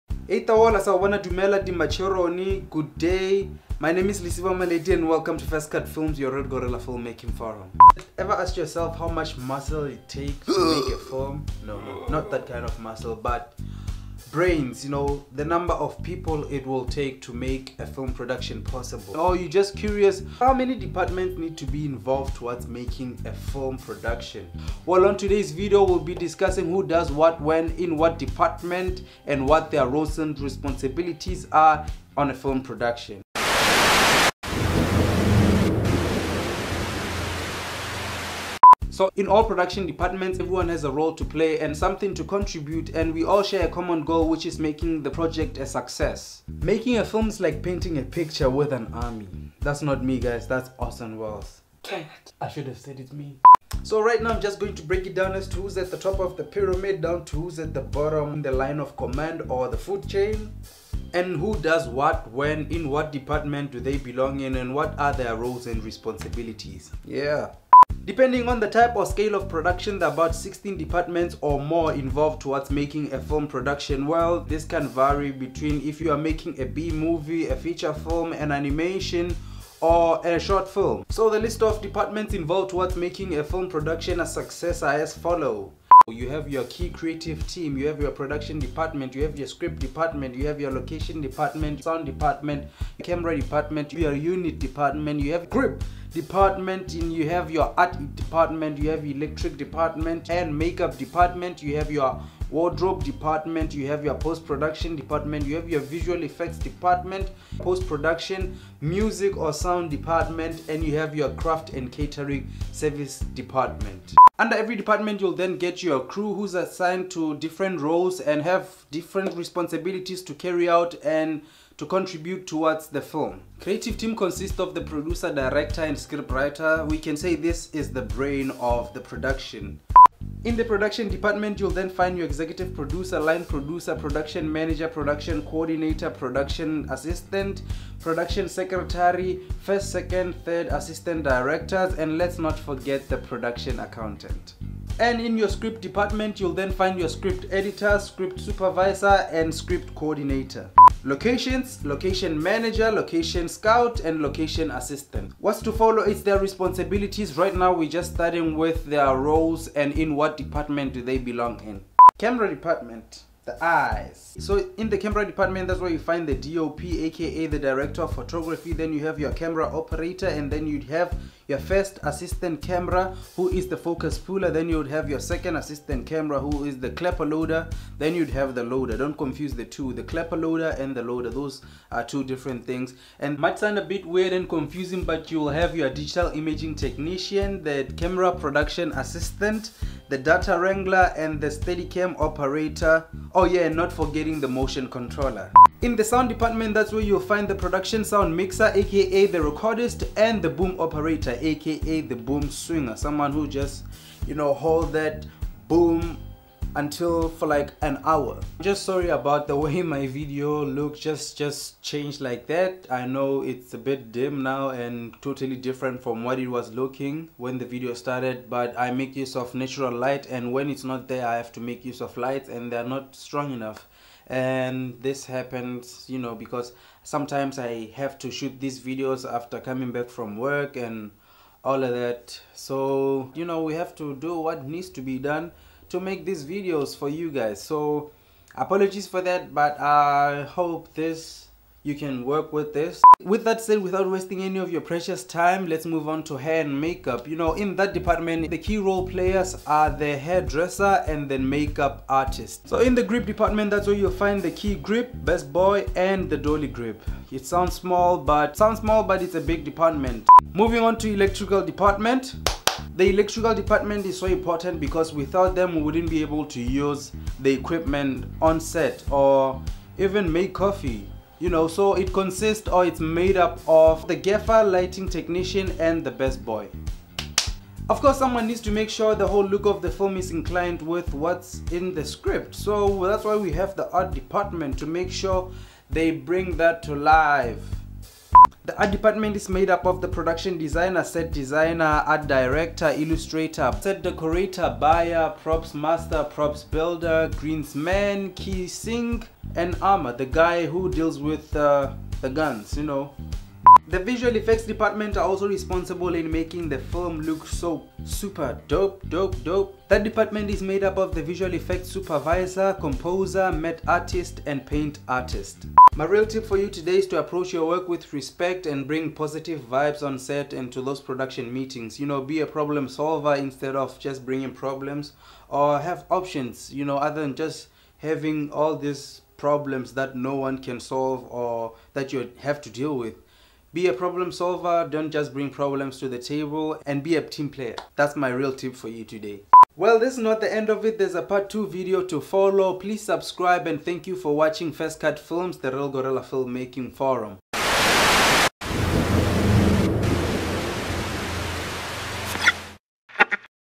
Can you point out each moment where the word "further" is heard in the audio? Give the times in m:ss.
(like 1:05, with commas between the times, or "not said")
not said.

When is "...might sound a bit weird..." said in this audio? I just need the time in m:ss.
3:03.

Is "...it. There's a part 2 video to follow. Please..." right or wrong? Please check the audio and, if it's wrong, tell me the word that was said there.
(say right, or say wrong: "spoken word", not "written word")
right.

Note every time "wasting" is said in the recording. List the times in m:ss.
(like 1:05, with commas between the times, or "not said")
4:04.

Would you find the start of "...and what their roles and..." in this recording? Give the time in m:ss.
0:29.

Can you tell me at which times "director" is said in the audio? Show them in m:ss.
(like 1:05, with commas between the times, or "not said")
2:05, 2:21, 2:47, 4:52.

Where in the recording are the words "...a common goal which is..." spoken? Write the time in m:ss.
0:43.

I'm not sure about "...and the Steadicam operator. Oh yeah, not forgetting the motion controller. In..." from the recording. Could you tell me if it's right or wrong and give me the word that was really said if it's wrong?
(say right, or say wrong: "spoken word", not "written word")
right.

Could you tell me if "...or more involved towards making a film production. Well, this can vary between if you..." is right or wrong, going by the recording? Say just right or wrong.
right.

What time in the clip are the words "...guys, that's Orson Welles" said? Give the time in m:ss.
0:50.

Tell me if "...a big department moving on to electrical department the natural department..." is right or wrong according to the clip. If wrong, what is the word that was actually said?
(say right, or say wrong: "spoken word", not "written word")
wrong: "electrical", not "natural".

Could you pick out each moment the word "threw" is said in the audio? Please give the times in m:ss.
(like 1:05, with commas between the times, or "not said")
not said.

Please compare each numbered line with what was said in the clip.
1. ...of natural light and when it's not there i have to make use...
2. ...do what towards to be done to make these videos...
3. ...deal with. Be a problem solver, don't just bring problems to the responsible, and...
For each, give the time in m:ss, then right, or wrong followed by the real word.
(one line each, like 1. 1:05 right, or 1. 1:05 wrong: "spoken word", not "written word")
1. 3:39 right
2. 3:54 wrong: "needs", not "towards"
3. 5:32 wrong: "table", not "responsible".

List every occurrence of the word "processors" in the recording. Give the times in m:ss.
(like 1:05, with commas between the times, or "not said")
not said.